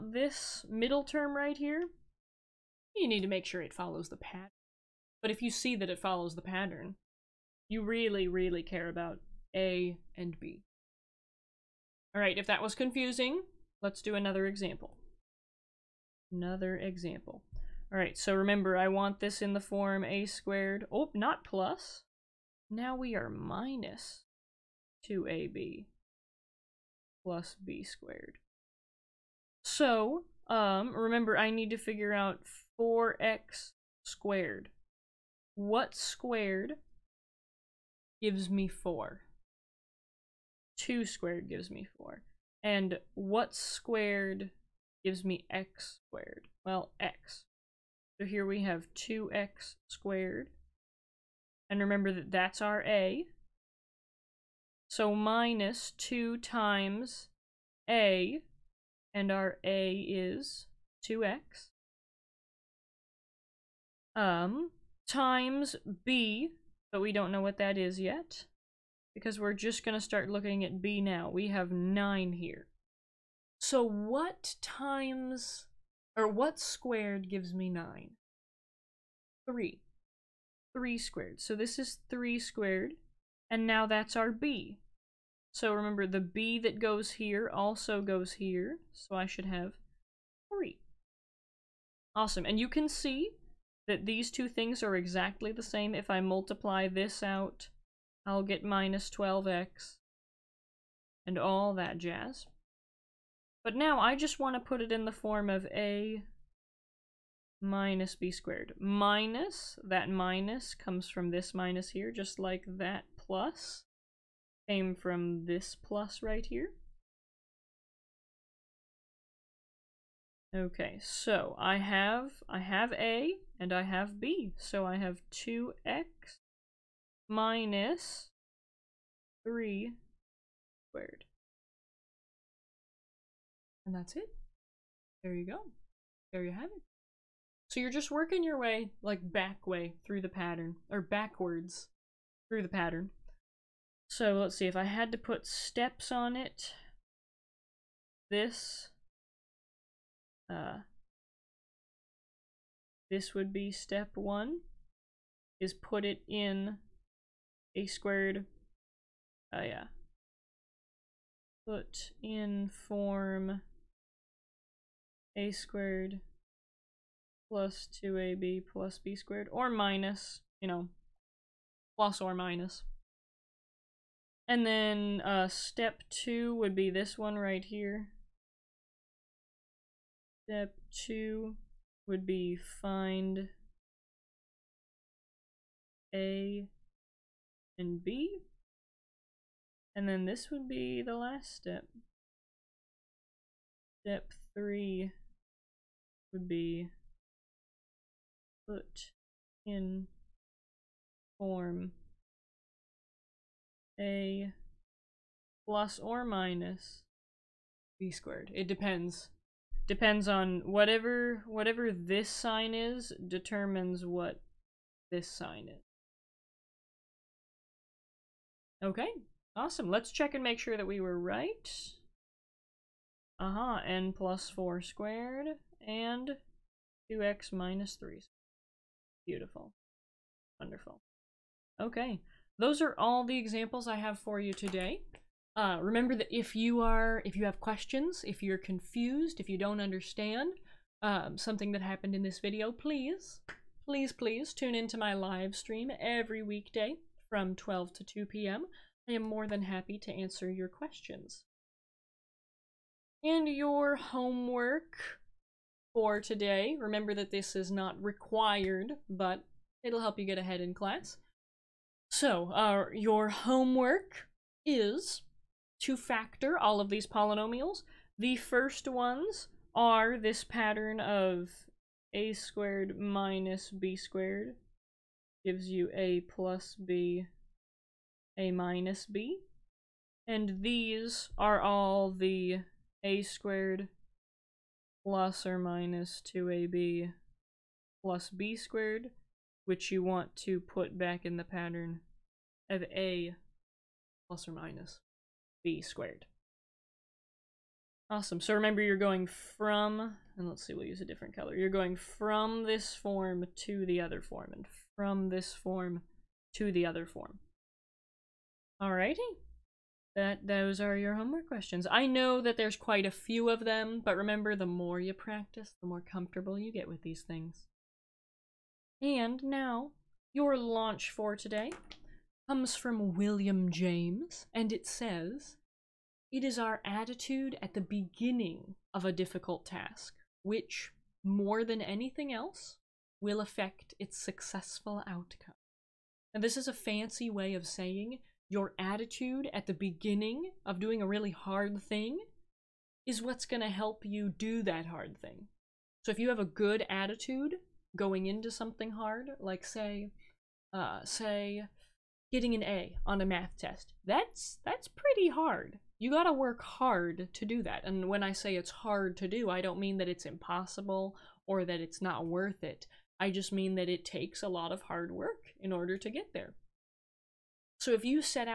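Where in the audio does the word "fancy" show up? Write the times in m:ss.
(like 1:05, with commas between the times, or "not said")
5:36.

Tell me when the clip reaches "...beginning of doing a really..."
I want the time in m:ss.
5:39.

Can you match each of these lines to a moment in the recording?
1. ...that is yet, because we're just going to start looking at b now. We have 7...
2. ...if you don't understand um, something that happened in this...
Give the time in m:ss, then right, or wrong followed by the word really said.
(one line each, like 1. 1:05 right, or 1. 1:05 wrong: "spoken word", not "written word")
1. 1:07 wrong: "9", not "7"
2. 3:59 right.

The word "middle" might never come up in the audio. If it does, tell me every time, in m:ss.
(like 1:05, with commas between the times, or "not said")
0:00.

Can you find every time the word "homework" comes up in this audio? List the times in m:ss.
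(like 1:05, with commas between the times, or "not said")
4:13, 4:23, 5:11.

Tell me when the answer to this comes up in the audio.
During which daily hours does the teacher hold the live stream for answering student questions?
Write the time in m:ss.
4:07.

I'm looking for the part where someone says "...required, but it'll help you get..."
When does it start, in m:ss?
4:18.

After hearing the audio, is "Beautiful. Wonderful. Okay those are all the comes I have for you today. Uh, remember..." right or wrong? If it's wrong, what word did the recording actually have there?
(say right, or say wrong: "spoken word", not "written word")
wrong: "examples", not "comes".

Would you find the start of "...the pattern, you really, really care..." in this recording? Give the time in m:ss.
0:06.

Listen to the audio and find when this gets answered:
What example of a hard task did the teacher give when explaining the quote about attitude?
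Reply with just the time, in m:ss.
5:52.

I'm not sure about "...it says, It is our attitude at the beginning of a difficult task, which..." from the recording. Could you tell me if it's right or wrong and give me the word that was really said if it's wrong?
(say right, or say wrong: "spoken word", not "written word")
right.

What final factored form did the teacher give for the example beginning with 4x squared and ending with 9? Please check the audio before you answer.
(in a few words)
2x minus 3 squared.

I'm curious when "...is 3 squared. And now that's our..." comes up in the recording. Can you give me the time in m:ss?
1:21.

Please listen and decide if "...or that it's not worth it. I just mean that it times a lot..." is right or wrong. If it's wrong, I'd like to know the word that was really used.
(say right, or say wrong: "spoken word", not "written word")
wrong: "takes", not "times".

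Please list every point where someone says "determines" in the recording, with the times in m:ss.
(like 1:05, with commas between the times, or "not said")
3:33.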